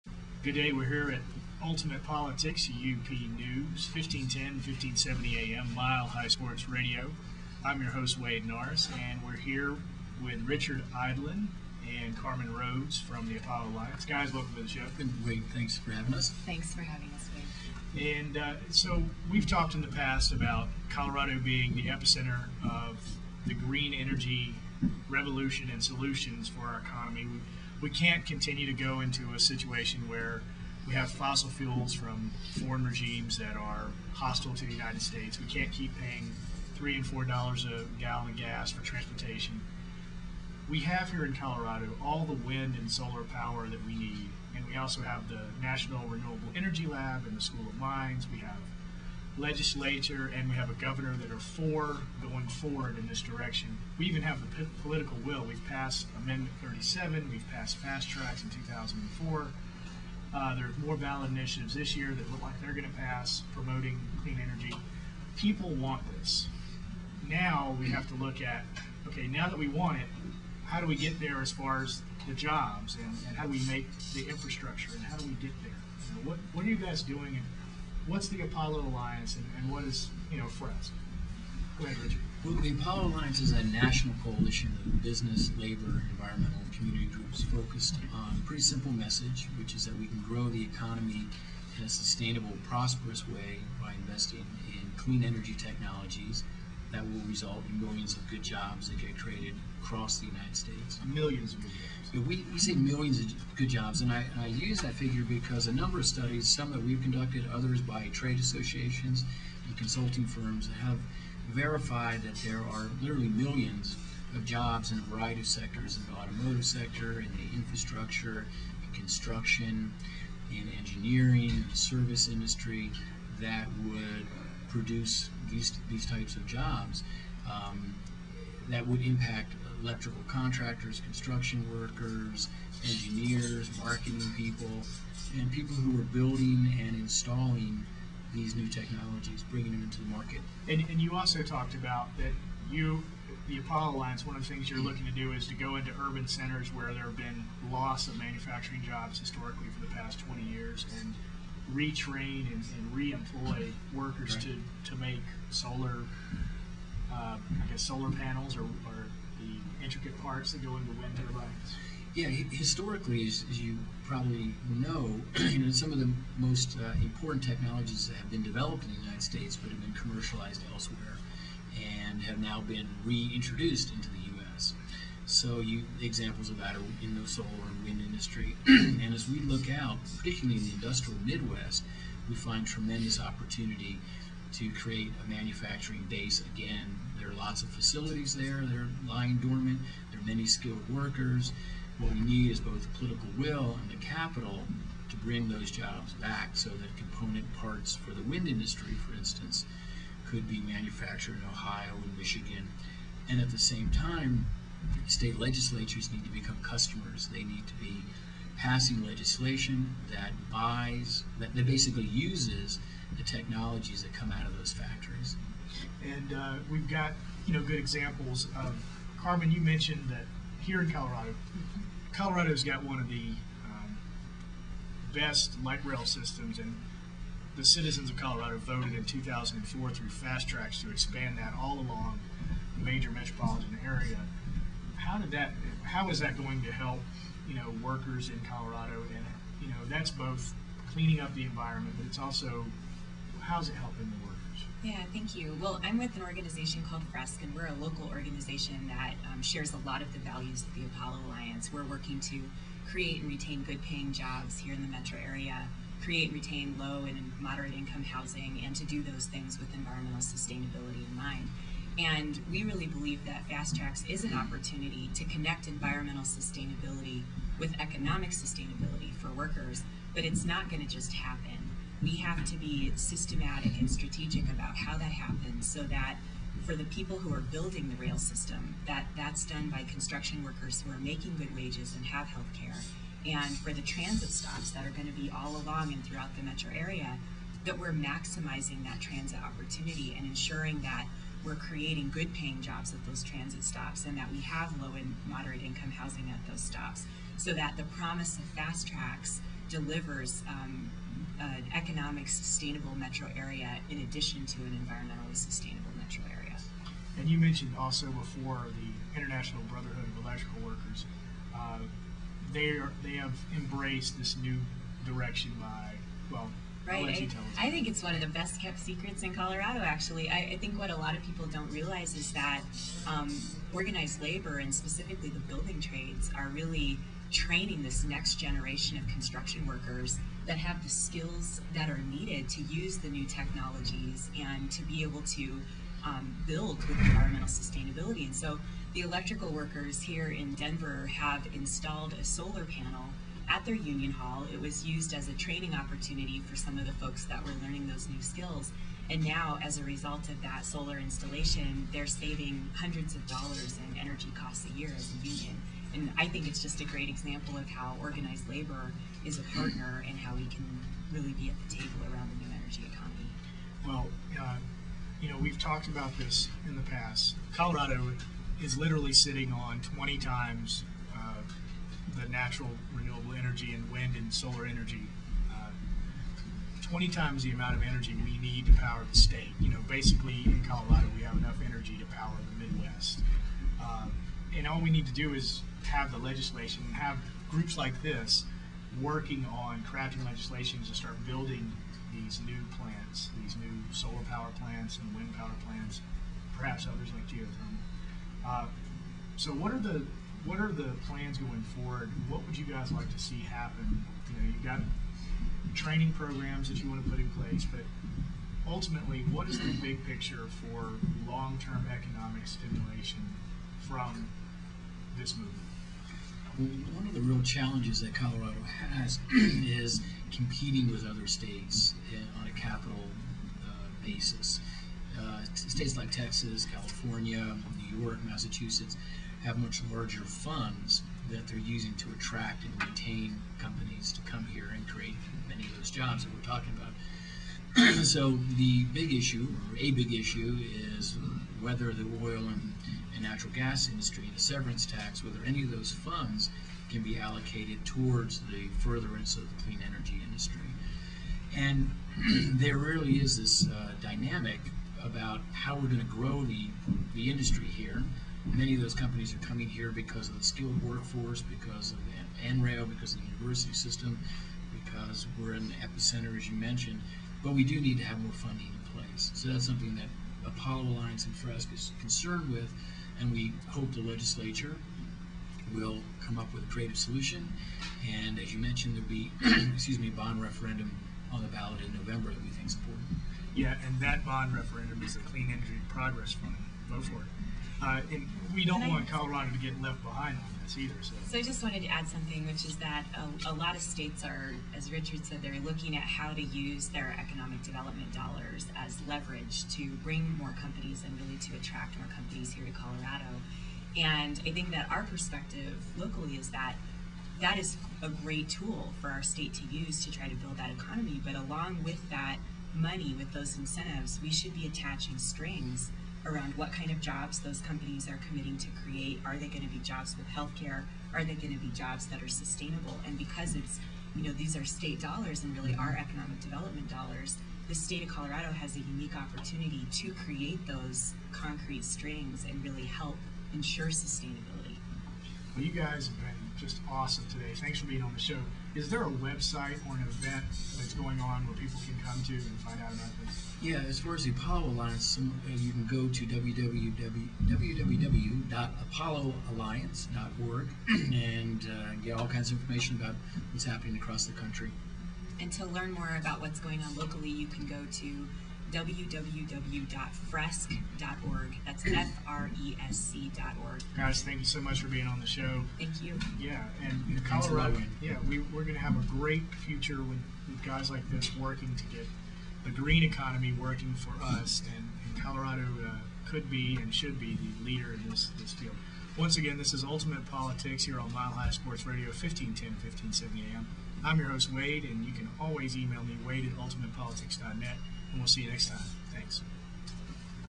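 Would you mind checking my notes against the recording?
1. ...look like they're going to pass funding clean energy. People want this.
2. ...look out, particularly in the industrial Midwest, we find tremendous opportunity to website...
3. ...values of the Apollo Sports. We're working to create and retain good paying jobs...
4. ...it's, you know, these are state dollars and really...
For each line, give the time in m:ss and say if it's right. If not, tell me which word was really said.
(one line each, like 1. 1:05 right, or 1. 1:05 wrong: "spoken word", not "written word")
1. 1:02 wrong: "promoting", not "funding"
2. 2:59 wrong: "create", not "website"
3. 4:10 wrong: "Alliance", not "Sports"
4. 8:43 right.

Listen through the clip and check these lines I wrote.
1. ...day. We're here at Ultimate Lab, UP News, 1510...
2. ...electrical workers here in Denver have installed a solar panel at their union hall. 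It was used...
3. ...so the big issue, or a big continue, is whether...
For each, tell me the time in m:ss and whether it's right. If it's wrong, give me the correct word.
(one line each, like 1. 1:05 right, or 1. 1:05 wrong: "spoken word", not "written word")
1. 0:00 wrong: "Politics", not "Lab"
2. 5:39 right
3. 7:18 wrong: "issue", not "continue".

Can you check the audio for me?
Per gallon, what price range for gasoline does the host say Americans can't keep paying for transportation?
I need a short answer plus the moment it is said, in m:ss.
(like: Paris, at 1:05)
three and four dollars, at 0:36.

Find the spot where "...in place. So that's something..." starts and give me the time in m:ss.
7:48.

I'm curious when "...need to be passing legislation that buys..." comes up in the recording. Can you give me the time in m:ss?
3:27.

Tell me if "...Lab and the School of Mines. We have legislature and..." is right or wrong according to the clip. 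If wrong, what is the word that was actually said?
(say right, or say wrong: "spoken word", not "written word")
right.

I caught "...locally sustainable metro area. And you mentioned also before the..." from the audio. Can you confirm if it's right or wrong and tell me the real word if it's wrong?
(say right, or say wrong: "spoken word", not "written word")
wrong: "environmentally", not "locally".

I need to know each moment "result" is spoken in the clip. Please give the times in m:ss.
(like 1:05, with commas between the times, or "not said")
1:37, 5:49.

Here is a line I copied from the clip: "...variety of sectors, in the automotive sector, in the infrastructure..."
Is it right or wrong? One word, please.
right.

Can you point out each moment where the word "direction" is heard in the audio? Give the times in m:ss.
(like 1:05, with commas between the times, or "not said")
0:53, 5:15.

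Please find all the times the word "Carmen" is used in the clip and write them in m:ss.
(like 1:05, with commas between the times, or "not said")
0:12, 3:39.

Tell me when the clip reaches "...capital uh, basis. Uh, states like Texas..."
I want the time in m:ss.
7:02.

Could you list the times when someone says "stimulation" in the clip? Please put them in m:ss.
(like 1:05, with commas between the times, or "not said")
6:52.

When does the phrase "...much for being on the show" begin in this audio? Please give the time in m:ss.
9:24.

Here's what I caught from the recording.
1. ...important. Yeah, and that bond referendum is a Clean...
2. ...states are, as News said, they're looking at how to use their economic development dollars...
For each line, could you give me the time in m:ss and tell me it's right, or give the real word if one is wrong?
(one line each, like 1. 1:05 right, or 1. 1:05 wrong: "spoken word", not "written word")
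1. 8:02 right
2. 8:13 wrong: "Richard", not "News".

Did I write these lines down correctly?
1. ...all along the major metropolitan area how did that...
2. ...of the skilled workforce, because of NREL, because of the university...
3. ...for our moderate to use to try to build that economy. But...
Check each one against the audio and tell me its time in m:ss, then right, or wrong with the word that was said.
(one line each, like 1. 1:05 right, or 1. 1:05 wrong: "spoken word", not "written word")
1. 3:51 right
2. 7:40 right
3. 8:29 wrong: "state", not "moderate".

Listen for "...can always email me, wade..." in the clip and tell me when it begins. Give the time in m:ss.
9:45.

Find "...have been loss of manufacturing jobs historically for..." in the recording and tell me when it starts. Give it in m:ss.
2:27.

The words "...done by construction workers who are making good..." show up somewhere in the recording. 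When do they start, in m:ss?
4:39.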